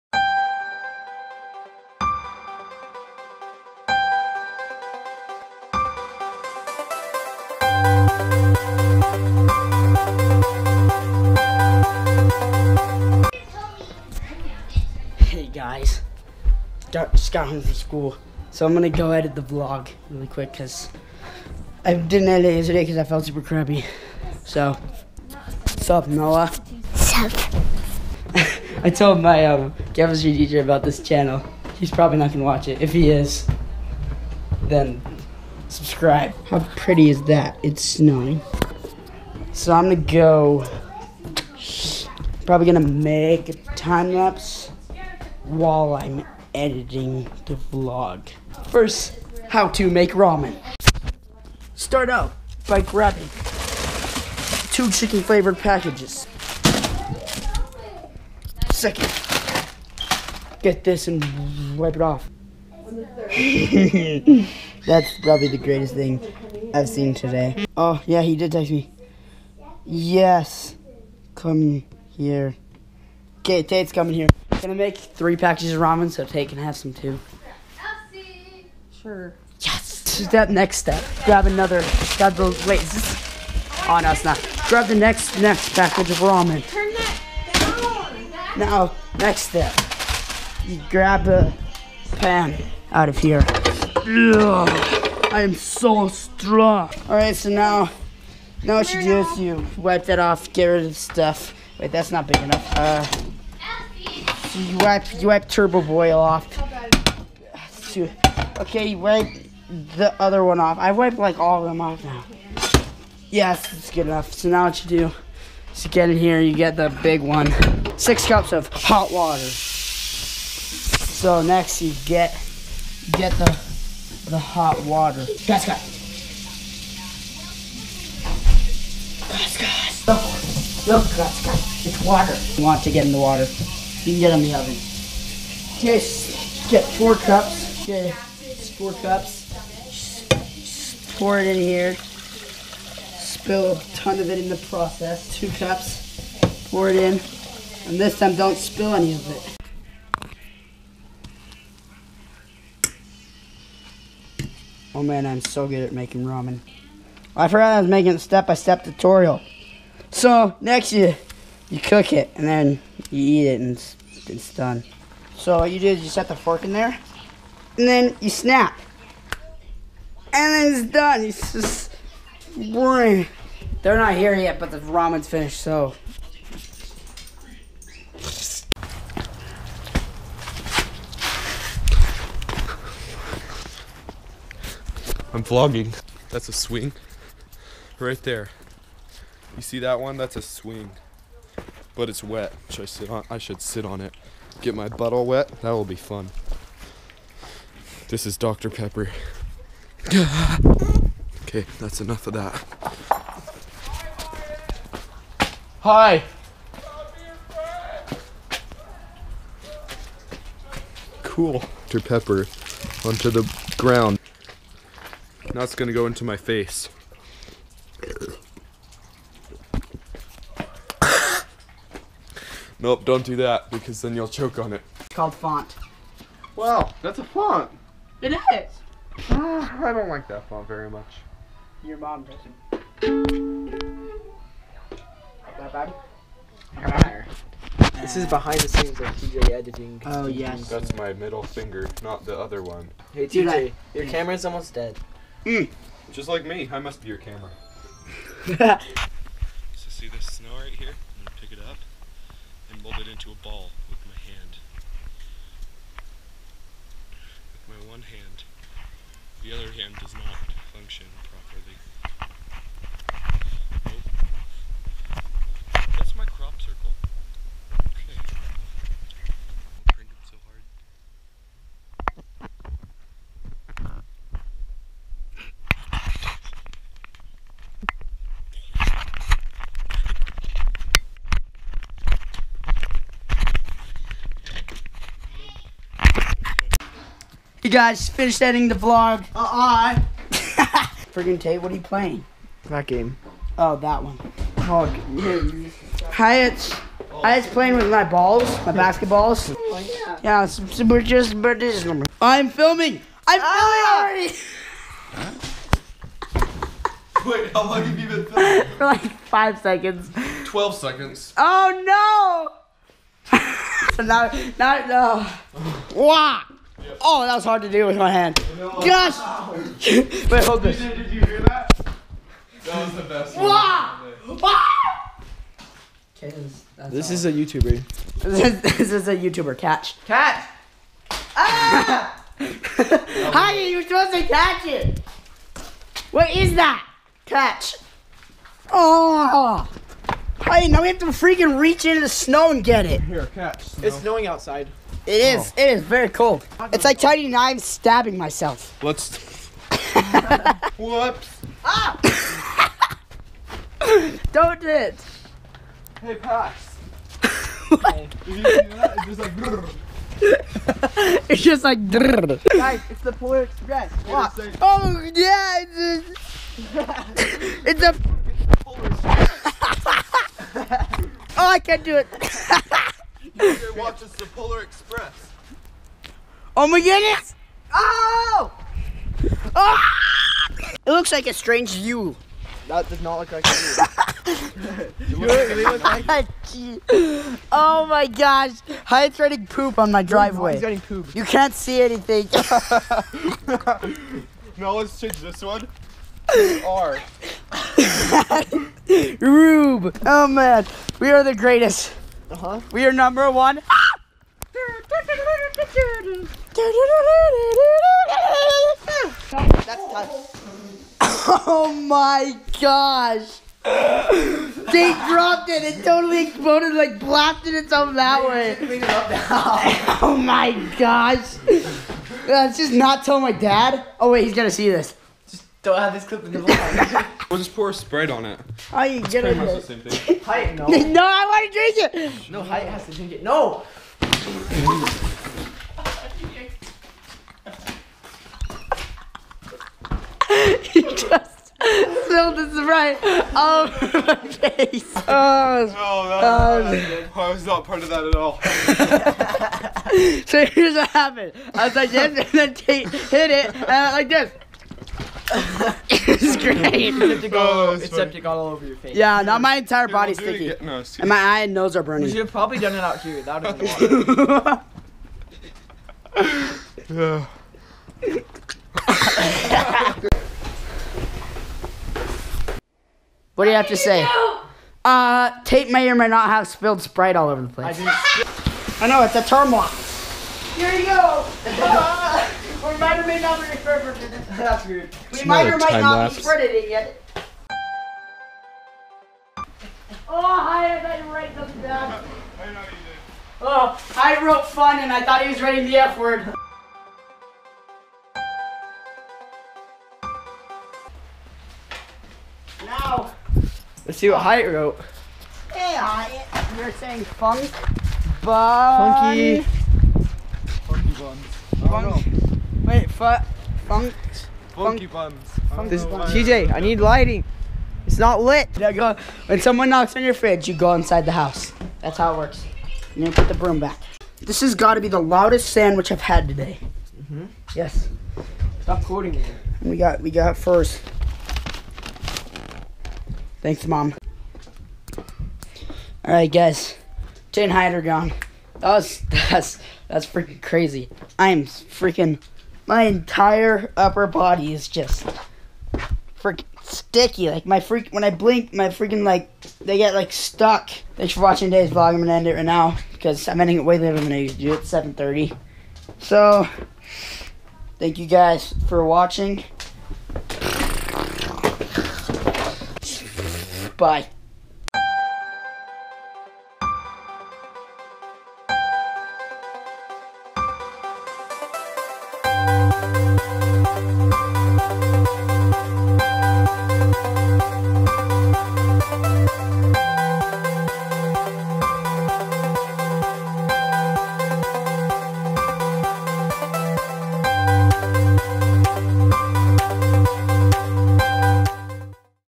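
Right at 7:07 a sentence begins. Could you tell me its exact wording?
we'll just pour a spread on it.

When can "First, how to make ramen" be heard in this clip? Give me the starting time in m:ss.
0:48.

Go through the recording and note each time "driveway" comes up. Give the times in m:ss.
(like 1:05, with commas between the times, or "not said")
6:30.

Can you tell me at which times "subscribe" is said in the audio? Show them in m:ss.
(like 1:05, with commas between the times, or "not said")
0:35.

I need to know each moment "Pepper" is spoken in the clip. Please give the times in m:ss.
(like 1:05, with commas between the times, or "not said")
3:18, 3:32.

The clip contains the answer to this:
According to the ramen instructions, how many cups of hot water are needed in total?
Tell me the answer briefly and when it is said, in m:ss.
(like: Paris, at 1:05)
6, at 1:57.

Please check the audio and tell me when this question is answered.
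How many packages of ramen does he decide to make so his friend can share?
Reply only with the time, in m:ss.
1:14.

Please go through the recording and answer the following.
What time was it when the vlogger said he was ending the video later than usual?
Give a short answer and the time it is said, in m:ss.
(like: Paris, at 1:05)
7:30, at 9:14.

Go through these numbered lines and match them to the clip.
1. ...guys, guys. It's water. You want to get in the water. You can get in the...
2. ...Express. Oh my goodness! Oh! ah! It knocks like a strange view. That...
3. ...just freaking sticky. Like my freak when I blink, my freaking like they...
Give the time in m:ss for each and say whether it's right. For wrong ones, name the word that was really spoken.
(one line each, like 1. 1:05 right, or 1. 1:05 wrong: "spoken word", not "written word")
1. 2:11 right
2. 6:14 wrong: "looks", not "knocks"
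3. 9:04 right.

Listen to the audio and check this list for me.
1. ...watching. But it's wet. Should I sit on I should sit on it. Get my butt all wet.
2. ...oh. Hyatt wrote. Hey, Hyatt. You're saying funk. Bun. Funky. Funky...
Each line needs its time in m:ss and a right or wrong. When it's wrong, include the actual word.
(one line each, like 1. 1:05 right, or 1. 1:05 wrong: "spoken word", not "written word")
1. 3:10 wrong: "swing", not "watching"
2. 8:24 right.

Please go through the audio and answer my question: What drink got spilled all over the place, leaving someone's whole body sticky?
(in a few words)
Sprite.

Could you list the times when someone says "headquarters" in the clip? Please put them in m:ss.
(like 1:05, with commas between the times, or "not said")
not said.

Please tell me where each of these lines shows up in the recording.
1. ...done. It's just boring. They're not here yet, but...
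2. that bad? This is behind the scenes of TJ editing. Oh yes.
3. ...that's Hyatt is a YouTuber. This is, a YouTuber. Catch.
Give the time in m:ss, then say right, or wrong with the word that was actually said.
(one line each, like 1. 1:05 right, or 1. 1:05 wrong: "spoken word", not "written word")
1. 2:50 right
2. 3:55 right
3. 5:26 wrong: "This", not "Hyatt".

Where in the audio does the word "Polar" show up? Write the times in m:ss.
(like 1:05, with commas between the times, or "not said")
6:03, 6:14.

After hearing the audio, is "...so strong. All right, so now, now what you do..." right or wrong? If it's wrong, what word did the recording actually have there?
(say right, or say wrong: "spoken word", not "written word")
right.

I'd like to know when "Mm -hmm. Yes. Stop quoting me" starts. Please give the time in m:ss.
8:46.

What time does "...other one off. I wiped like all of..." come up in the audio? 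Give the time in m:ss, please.
1:50.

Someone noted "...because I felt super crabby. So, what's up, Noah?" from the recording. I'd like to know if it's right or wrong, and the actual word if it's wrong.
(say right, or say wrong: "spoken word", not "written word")
right.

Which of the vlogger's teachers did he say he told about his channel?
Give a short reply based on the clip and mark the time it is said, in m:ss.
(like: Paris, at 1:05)
Chemistry teacher, at 0:29.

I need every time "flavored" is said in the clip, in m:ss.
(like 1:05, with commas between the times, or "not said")
0:55.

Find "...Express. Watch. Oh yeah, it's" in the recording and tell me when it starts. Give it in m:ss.
6:03.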